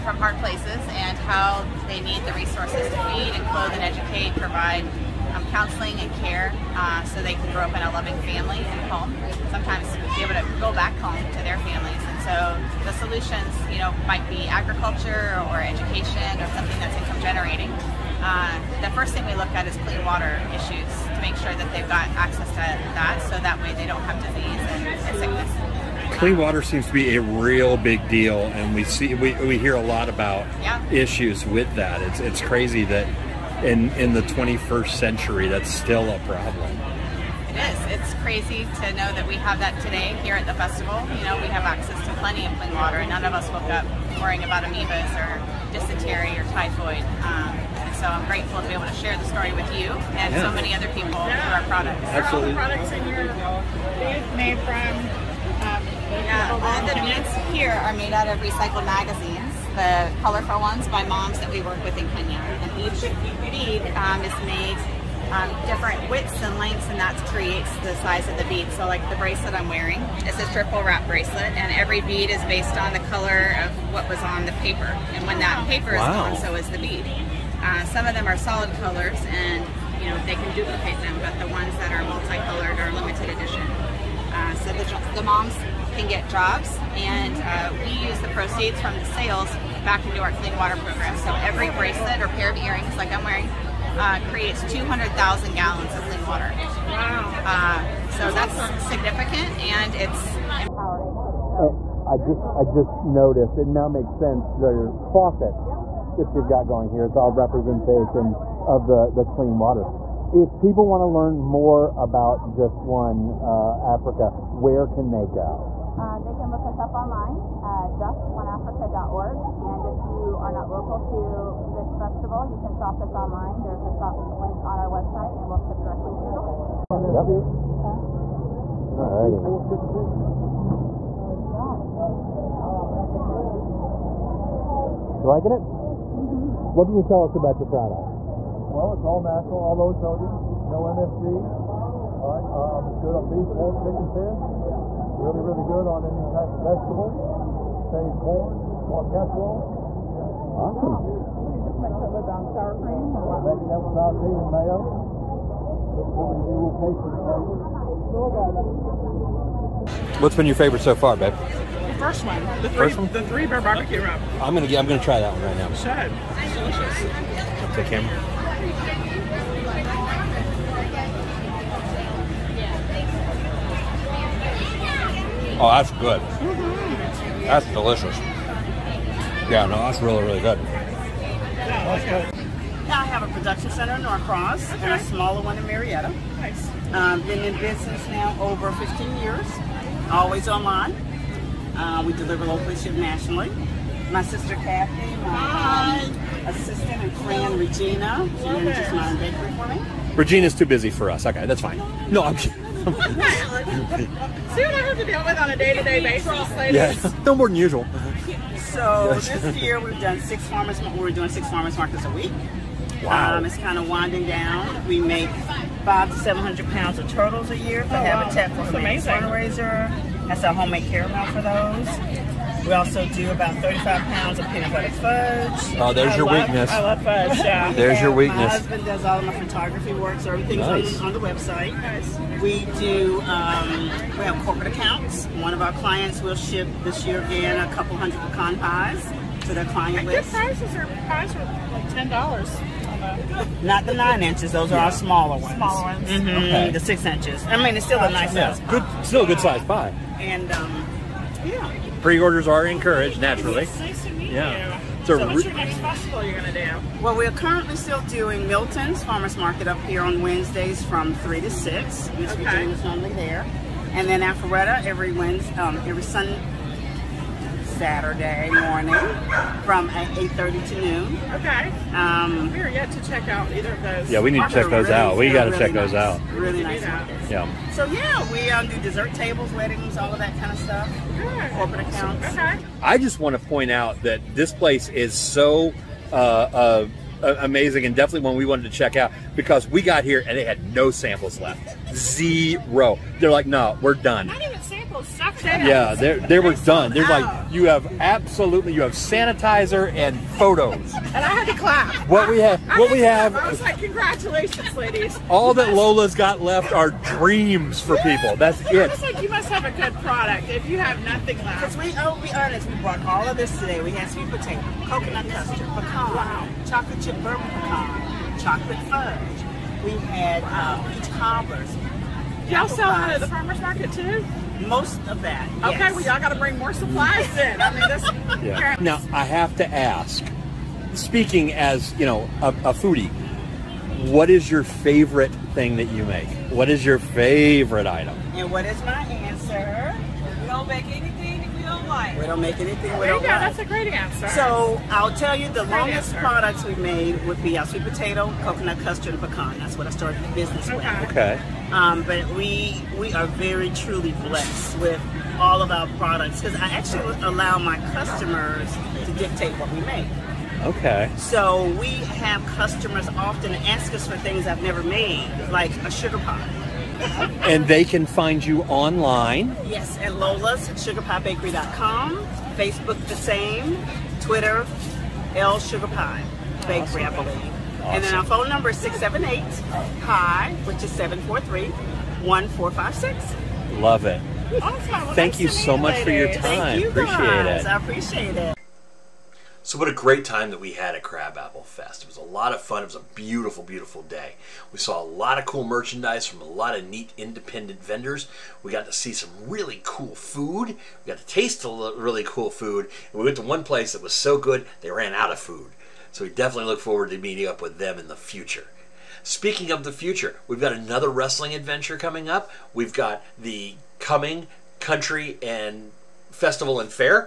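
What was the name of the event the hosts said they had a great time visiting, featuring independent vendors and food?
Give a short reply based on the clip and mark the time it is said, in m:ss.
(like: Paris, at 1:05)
Crabapple Fest, at 6:31.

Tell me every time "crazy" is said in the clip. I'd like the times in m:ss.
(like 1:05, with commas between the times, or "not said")
0:32, 0:38.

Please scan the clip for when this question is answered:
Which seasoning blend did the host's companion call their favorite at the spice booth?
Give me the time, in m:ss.
2:43.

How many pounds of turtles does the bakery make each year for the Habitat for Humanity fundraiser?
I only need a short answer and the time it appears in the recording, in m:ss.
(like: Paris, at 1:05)
500 to 700 pounds, at 3:35.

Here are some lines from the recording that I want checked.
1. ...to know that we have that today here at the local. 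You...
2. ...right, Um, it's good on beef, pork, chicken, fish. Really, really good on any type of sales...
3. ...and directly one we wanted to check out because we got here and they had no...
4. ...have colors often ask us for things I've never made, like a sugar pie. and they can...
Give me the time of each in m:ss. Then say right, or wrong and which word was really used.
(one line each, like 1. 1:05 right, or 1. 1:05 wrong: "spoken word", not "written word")
1. 0:38 wrong: "festival", not "local"
2. 2:22 wrong: "vegetables", not "sales"
3. 4:47 wrong: "definitely", not "directly"
4. 6:01 wrong: "customers", not "colors".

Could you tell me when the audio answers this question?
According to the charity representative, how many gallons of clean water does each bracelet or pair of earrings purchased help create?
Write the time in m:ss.
1:34.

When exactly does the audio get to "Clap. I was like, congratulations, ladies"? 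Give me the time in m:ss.
5:03.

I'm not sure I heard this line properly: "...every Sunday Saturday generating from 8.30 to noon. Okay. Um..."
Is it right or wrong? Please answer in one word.
wrong.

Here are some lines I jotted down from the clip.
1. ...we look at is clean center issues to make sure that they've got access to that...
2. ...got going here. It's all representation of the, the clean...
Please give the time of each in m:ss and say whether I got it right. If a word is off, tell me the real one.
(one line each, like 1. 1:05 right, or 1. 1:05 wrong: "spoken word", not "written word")
1. 0:19 wrong: "water", not "center"
2. 1:46 right.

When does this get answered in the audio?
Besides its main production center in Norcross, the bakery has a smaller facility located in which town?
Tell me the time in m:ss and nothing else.
3:05.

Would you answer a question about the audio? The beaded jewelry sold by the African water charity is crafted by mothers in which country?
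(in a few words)
Kenya.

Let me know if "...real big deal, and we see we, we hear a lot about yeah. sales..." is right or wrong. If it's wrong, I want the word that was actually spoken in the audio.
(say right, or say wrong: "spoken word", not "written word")
wrong: "issues", not "sales".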